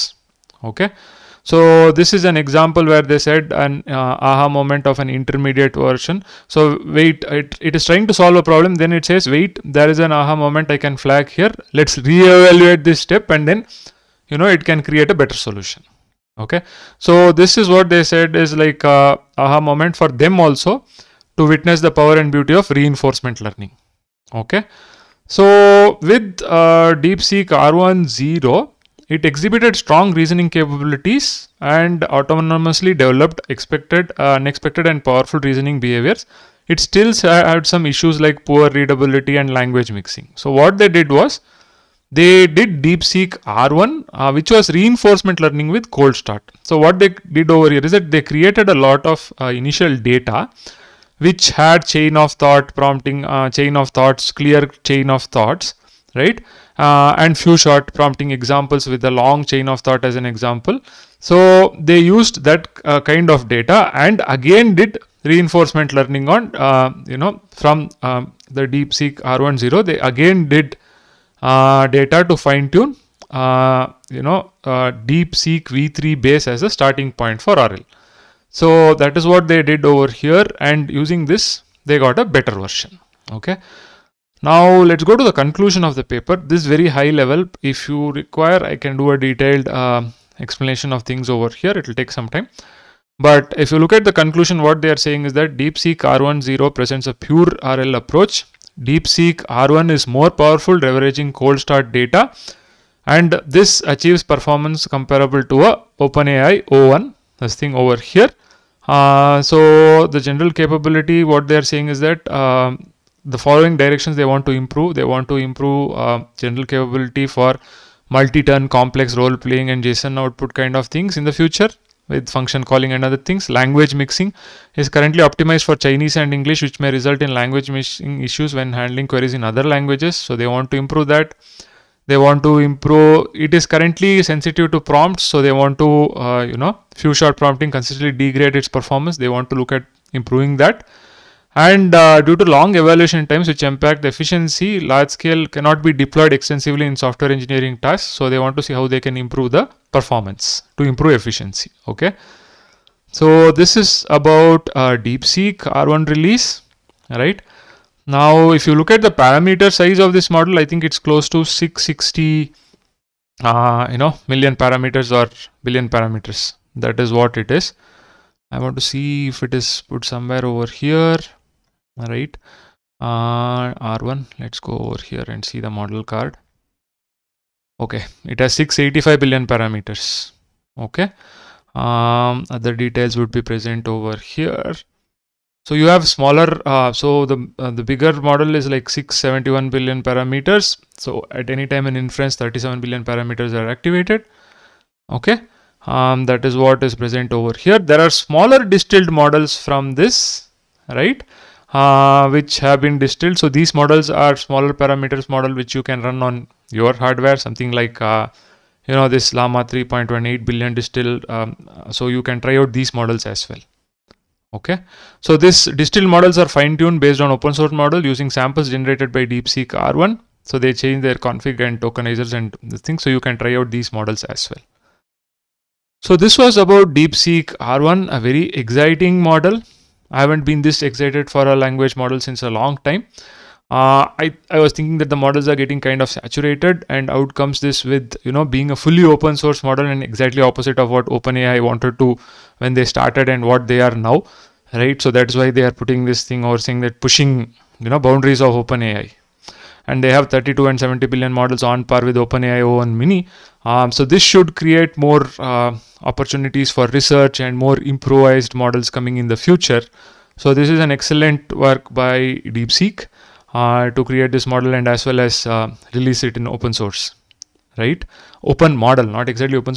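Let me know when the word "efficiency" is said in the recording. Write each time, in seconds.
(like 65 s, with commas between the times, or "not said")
144 s, 151 s.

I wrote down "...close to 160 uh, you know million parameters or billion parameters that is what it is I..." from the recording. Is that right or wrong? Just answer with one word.
wrong.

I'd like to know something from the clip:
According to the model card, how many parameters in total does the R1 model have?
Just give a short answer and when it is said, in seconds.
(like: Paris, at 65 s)
685 billion, at 178 s.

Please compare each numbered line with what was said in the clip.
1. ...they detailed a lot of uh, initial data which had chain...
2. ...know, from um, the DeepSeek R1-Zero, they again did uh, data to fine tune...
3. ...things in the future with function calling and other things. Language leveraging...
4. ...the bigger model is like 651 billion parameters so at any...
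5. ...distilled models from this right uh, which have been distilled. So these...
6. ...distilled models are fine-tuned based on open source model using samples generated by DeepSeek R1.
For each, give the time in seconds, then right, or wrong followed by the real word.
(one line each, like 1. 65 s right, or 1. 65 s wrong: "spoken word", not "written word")
1. 48 s wrong: "created", not "detailed"
2. 67 s right
3. 120 s wrong: "mixing", not "leveraging"
4. 187 s wrong: "671", not "651"
5. 198 s right
6. 215 s right.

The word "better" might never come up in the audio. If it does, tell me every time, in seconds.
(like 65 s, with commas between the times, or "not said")
15 s, 82 s.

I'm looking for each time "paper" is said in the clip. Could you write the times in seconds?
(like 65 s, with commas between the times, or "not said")
86 s.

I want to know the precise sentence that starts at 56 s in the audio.
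uh, and few-shot prompting examples with the long chain of thought as an example.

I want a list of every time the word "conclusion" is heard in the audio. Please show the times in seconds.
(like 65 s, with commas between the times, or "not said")
85 s, 94 s.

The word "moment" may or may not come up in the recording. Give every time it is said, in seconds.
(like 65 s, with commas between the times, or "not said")
4 s, 10 s, 19 s.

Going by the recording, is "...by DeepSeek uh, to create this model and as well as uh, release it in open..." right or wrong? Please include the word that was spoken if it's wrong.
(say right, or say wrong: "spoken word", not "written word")
right.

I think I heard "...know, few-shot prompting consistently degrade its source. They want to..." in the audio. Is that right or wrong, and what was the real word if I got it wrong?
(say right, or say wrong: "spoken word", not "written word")
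wrong: "performance", not "source".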